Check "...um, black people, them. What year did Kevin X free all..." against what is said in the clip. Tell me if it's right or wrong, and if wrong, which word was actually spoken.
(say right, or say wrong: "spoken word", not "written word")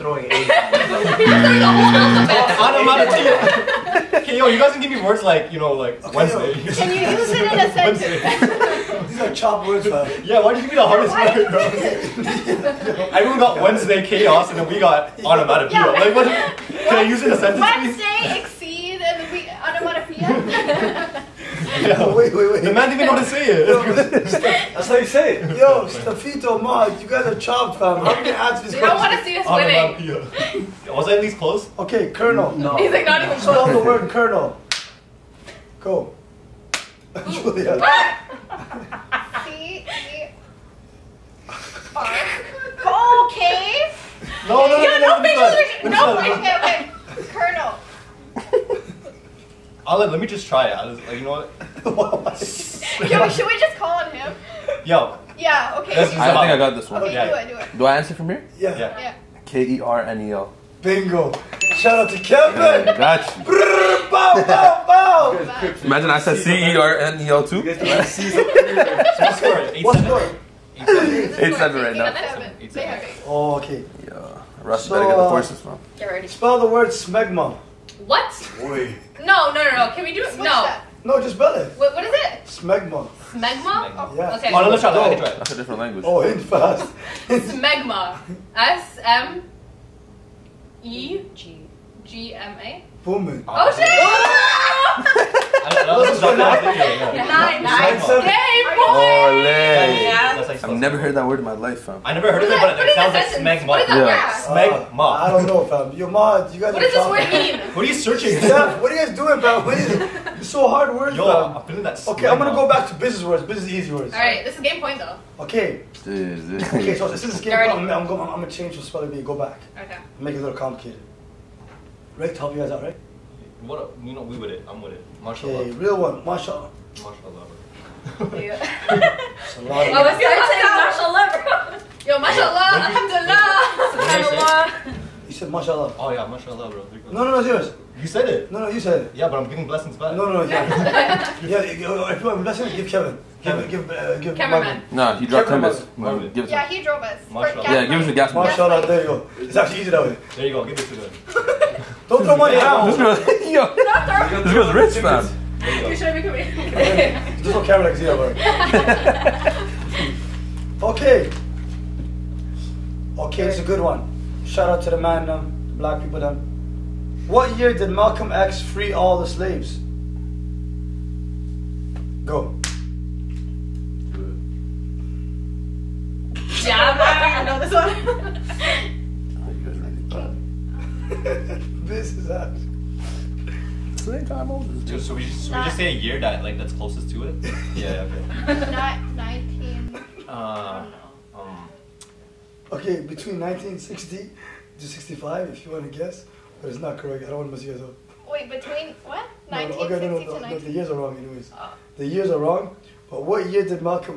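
wrong: "Malcolm", not "Kevin".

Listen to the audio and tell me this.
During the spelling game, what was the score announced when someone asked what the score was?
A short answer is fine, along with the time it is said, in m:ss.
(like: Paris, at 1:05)
8-7, at 1:10.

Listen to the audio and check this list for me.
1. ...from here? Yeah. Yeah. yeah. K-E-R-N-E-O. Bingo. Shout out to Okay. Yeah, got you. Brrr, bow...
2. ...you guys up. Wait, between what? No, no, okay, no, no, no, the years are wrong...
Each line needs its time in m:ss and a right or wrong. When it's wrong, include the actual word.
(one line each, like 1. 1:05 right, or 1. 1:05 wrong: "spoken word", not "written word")
1. 0:58 wrong: "Kevin", not "Okay"
2. 3:17 right.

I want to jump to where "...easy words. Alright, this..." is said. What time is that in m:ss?
1:53.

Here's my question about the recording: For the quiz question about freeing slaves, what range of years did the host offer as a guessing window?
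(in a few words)
1960 to 65.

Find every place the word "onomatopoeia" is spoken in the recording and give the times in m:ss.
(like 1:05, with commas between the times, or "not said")
0:02, 0:15, 0:19.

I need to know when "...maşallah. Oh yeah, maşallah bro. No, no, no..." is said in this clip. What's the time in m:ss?
2:15.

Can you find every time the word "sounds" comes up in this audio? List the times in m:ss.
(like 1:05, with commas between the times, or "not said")
1:42.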